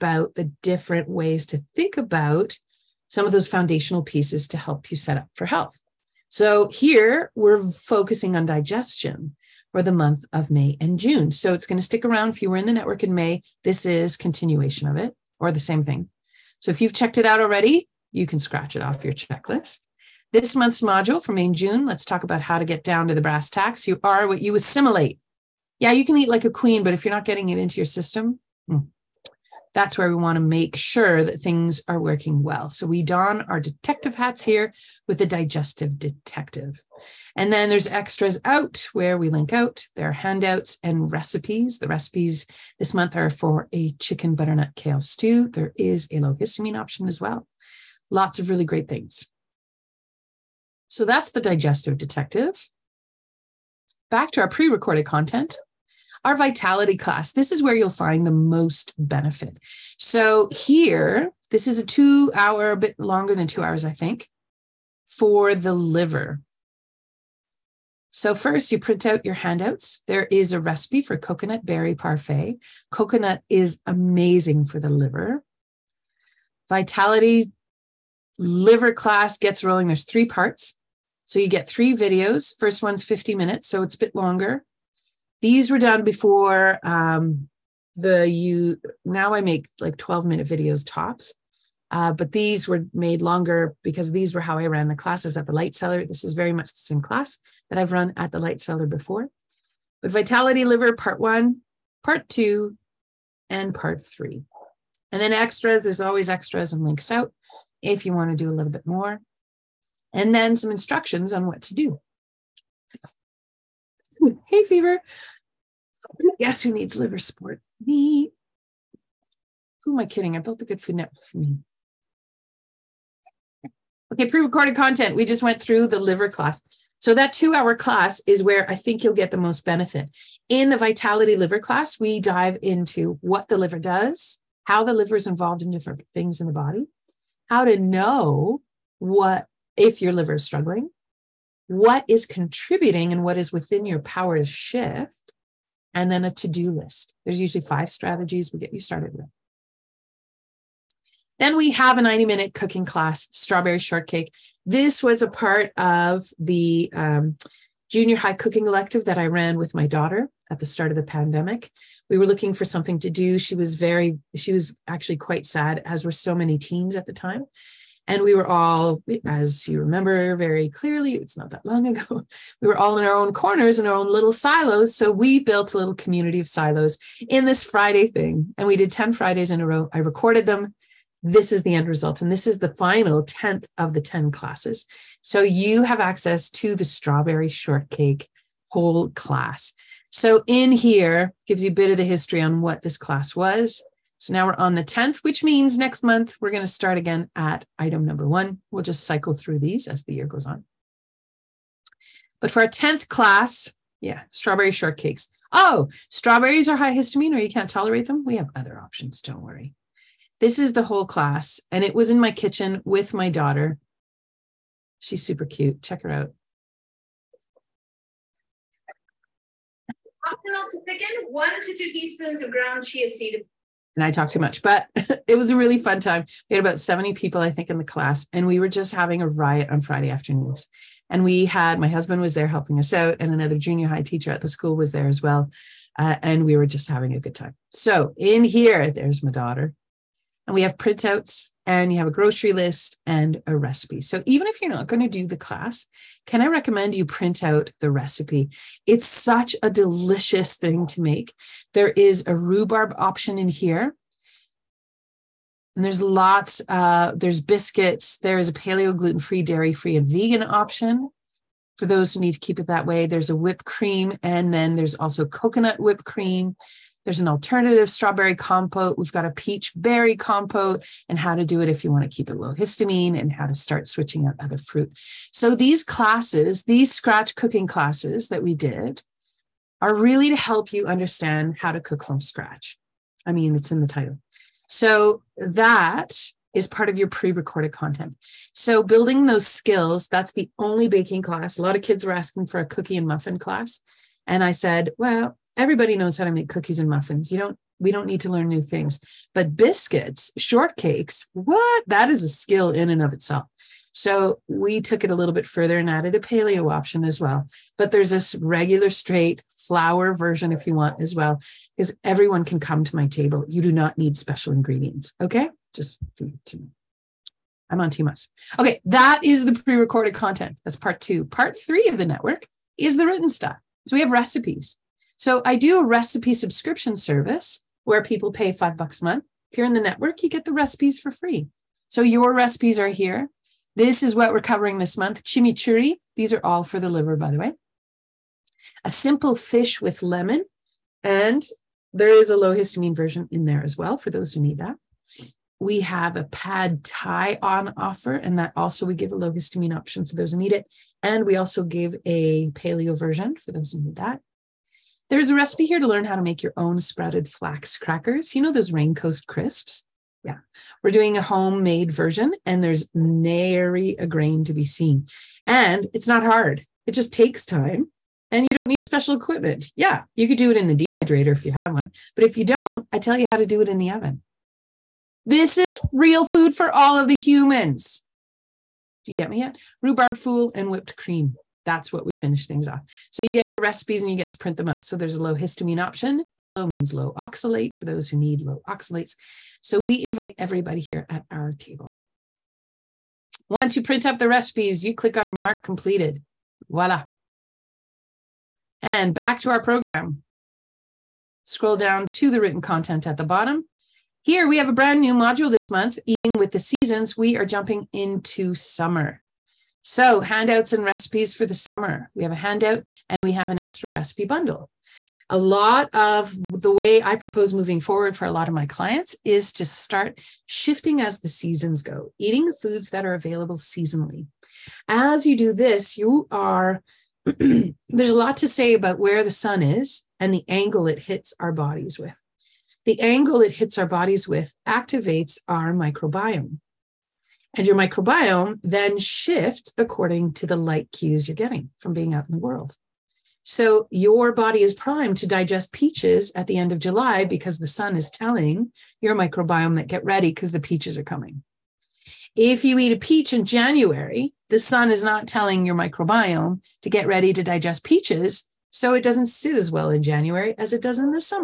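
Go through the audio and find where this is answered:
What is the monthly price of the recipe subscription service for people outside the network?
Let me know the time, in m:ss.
5:28.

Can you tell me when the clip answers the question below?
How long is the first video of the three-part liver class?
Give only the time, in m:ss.
1:23.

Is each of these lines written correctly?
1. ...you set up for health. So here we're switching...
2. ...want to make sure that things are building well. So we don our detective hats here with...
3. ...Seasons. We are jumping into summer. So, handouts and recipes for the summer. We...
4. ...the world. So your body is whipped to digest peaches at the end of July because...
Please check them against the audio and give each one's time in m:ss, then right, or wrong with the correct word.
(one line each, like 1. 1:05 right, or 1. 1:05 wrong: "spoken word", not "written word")
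1. 0:04 wrong: "focusing", not "switching"
2. 0:30 wrong: "working", not "building"
3. 6:46 right
4. 7:22 wrong: "primed", not "whipped".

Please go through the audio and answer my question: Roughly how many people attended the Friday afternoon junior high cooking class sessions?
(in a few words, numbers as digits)
70.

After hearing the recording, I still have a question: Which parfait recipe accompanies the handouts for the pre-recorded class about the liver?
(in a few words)
coconut berry parfait.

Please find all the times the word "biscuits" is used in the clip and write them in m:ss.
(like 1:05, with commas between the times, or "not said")
4:17, 4:59.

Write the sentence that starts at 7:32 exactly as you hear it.
If you eat a peach in January, the sun is not telling your microbiome to get ready to digest peaches.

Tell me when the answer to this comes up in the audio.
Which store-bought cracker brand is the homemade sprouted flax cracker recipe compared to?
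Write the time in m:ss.
5:58.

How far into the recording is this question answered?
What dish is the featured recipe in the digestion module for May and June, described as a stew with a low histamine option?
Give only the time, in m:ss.
0:43.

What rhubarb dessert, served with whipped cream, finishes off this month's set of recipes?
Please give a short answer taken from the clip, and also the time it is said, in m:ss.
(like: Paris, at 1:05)
Rhubarb fool, at 6:19.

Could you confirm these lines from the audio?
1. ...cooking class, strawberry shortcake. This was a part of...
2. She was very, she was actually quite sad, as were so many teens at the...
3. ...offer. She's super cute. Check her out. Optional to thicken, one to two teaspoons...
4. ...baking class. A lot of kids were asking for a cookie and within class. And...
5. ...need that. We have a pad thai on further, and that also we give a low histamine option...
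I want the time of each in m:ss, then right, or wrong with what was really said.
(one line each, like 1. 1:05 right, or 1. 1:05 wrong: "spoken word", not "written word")
1. 2:32 right
2. 2:43 right
3. 3:33 wrong: "daughter", not "offer"
4. 4:50 wrong: "muffin", not "within"
5. 5:44 wrong: "offer", not "further".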